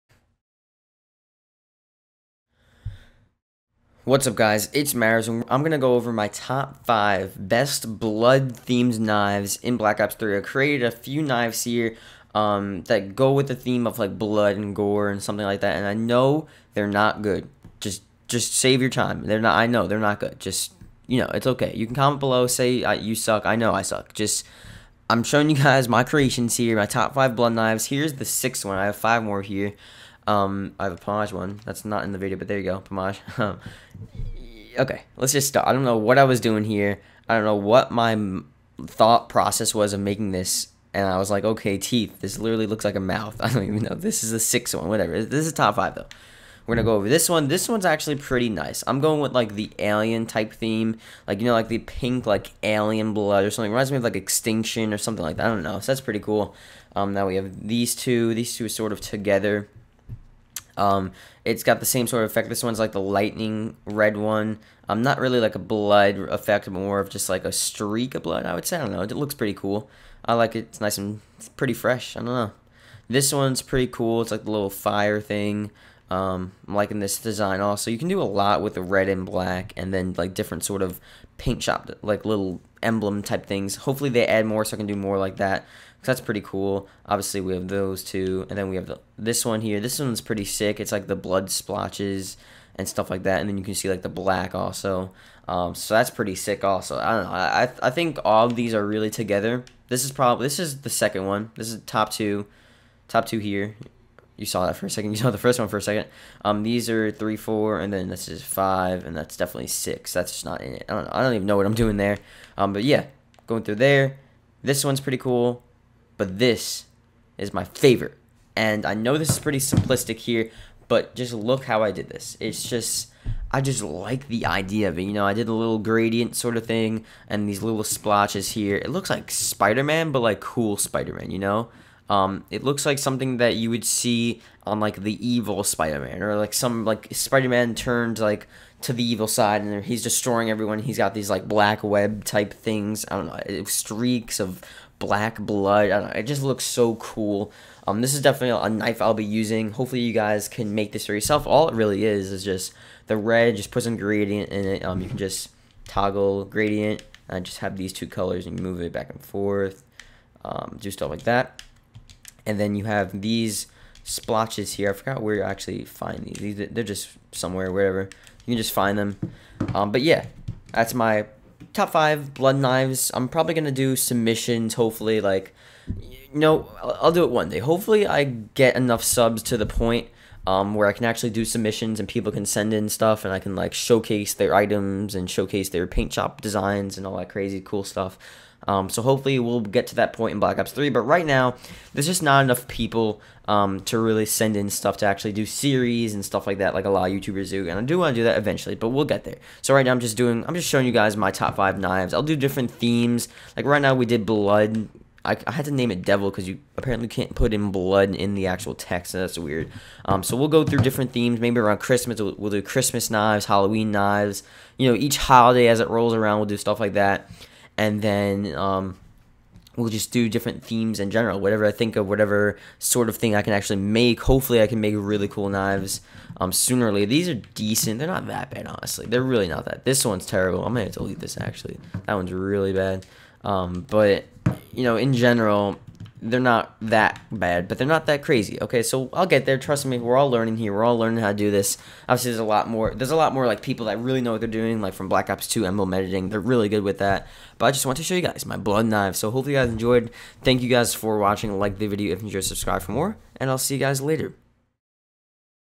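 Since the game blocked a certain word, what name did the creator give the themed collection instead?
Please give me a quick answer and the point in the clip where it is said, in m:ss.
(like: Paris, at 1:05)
Devil, at 3:26.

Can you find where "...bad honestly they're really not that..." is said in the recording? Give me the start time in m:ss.
3:48.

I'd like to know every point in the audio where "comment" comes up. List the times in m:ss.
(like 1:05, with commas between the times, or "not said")
0:21.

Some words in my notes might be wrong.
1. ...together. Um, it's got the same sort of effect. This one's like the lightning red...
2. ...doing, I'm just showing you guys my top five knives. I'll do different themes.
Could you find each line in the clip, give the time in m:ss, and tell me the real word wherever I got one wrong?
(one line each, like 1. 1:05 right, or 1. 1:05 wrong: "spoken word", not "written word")
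1. 0:59 right
2. 3:20 right.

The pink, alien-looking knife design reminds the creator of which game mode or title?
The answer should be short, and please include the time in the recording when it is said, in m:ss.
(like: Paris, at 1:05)
Extinction, at 0:54.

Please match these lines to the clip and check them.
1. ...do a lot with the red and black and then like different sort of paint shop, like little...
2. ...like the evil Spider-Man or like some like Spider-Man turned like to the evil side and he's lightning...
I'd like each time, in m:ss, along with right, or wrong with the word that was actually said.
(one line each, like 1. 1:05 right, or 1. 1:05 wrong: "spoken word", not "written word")
1. 1:18 right
2. 2:14 wrong: "destroying", not "lightning".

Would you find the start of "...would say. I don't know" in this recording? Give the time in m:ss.
1:08.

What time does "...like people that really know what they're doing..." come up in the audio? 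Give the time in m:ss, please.
4:03.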